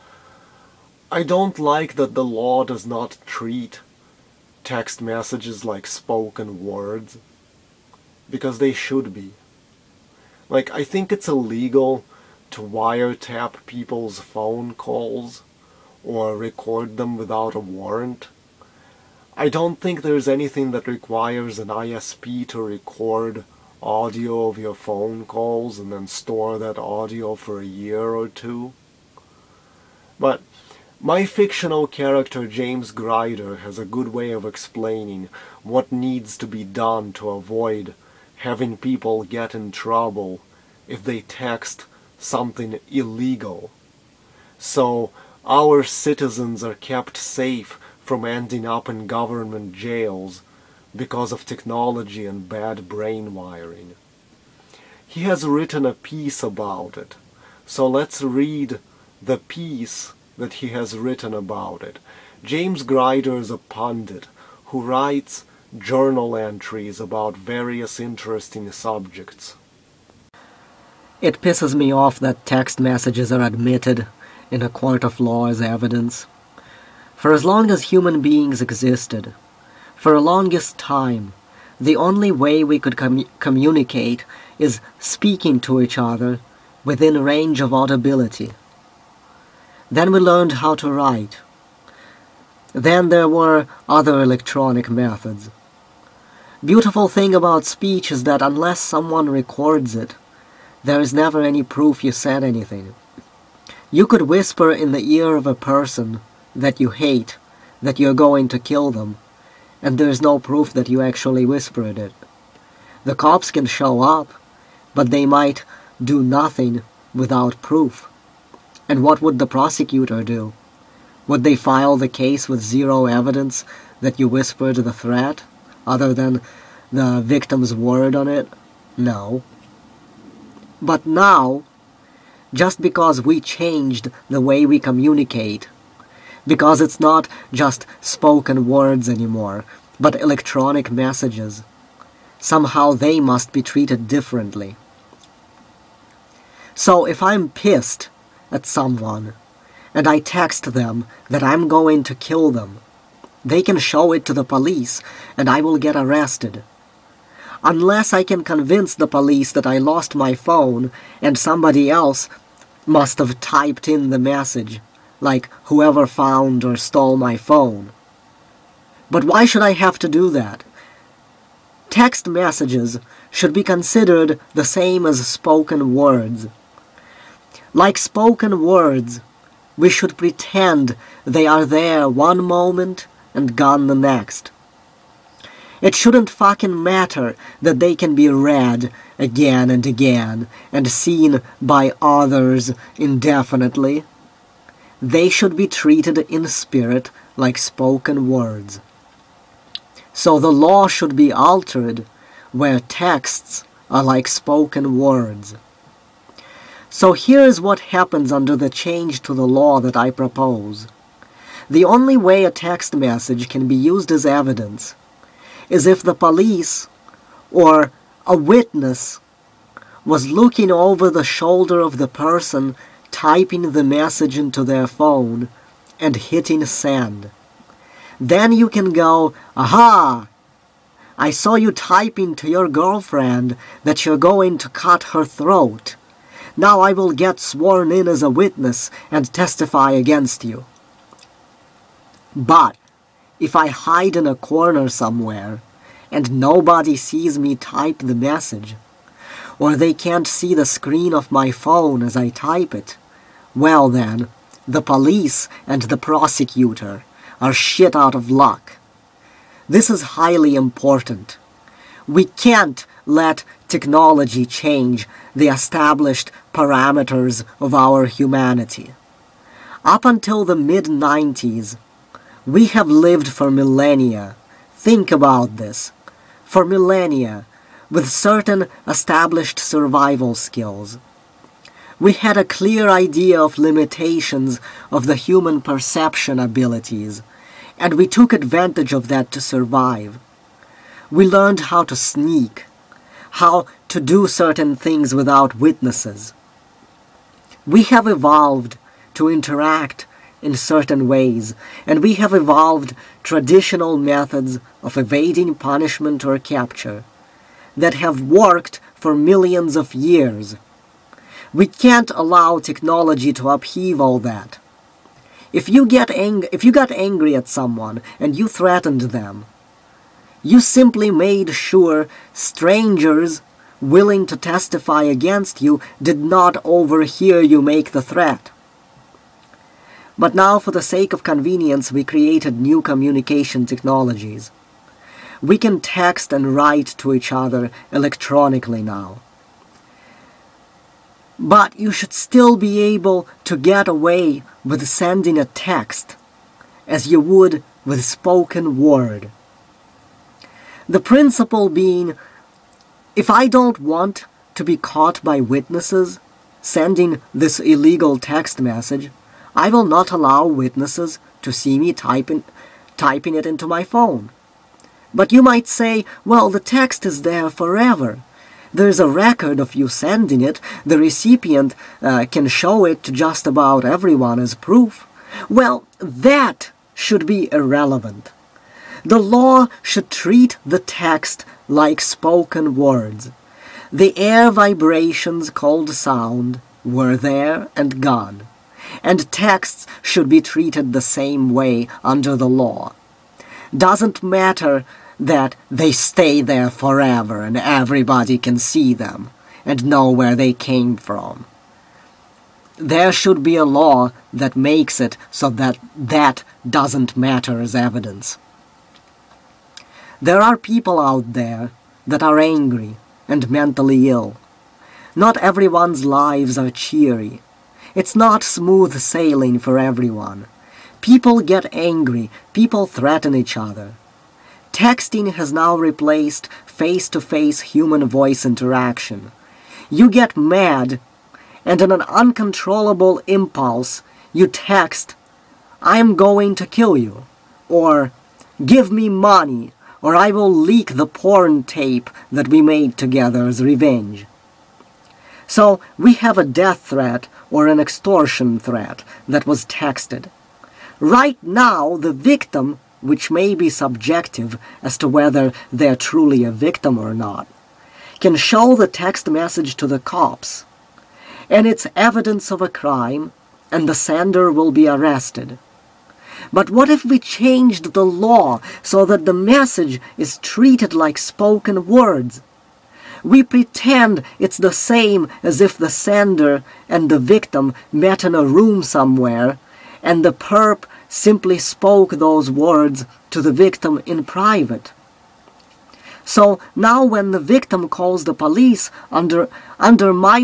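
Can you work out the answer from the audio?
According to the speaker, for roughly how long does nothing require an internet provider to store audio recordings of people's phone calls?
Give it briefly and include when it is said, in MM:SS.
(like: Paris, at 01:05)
a year or two, at 00:27.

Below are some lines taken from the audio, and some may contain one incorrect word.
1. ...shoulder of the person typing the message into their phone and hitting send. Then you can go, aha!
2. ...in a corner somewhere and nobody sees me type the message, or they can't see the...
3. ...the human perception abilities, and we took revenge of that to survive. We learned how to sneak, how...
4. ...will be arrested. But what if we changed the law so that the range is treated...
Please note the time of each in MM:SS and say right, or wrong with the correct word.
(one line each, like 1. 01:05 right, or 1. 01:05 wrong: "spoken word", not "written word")
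1. 03:41 right
2. 04:04 right
3. 04:45 wrong: "advantage", not "revenge"
4. 07:44 wrong: "message", not "range".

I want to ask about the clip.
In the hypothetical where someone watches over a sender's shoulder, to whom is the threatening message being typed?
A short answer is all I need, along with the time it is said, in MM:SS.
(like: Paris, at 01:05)
girlfriend, at 03:52.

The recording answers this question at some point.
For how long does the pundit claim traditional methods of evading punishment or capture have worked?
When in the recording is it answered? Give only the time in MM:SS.
05:09.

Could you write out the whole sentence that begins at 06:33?
Doesn't matter that they stay there forever and everybody can see them and know where they came from.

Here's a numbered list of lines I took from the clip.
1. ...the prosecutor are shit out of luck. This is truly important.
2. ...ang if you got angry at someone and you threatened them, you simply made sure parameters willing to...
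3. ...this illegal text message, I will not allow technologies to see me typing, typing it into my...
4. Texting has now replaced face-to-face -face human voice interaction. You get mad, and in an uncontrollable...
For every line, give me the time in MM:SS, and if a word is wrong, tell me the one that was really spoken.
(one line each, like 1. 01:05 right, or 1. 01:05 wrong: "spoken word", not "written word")
1. 04:15 wrong: "highly", not "truly"
2. 05:16 wrong: "strangers", not "parameters"
3. 05:57 wrong: "witnesses", not "technologies"
4. 07:04 right.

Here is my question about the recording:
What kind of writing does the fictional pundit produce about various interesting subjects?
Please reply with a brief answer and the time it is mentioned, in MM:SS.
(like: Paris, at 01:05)
journal entries, at 01:05.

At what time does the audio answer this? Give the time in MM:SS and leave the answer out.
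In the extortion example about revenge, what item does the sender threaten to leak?
07:21.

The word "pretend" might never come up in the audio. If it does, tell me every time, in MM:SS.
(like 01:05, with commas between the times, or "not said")
03:00, 07:53.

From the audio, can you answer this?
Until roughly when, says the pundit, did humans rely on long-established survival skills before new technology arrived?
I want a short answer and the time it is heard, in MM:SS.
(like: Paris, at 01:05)
mid-90s, at 04:30.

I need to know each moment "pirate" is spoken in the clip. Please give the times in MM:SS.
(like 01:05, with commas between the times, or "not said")
not said.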